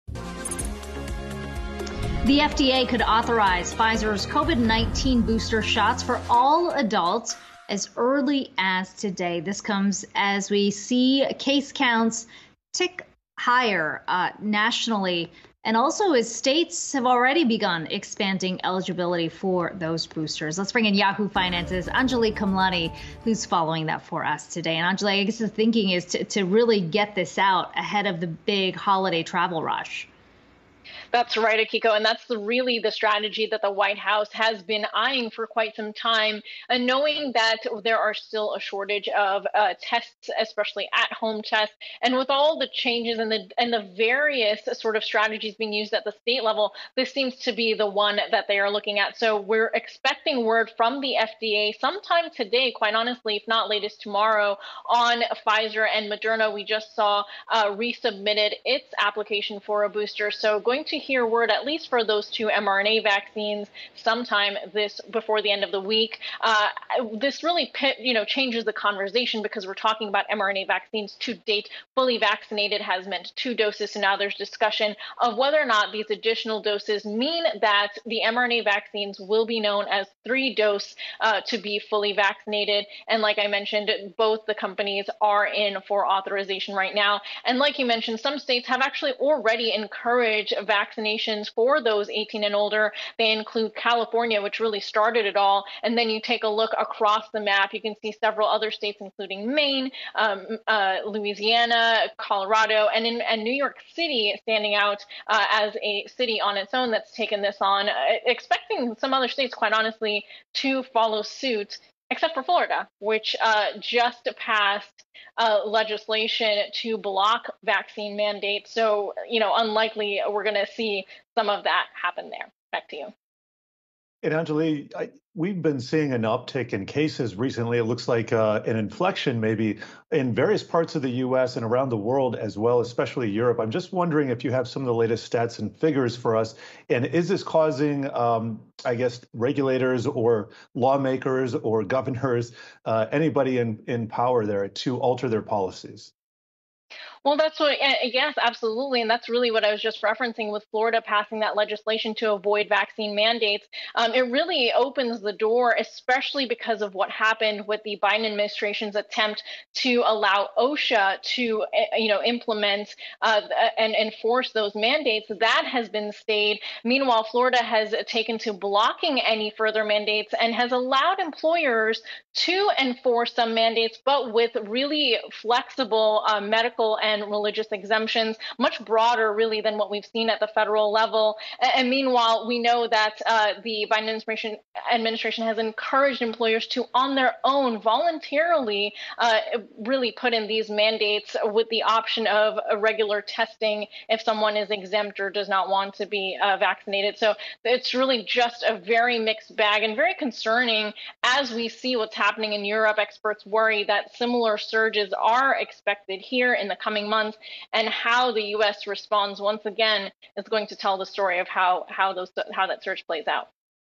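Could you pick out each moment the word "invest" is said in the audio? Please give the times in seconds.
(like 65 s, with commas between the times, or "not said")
not said.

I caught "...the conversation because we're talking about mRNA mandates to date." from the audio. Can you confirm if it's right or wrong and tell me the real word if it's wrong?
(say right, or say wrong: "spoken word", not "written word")
wrong: "vaccines", not "mandates".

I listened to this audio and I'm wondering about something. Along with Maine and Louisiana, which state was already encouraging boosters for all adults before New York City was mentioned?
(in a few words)
Colorado.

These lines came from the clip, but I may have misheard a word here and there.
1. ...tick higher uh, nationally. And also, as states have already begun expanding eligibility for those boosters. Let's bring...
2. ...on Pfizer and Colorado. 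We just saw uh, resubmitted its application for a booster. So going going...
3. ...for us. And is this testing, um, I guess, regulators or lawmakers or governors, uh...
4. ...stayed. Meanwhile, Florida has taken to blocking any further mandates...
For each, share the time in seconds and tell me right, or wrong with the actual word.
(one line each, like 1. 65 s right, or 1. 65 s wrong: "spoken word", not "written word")
1. 12 s right
2. 54 s wrong: "Moderna", not "Colorado"
3. 136 s wrong: "causing", not "testing"
4. 166 s right.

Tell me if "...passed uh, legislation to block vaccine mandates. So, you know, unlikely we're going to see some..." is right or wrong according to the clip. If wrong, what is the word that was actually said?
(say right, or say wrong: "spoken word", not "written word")
right.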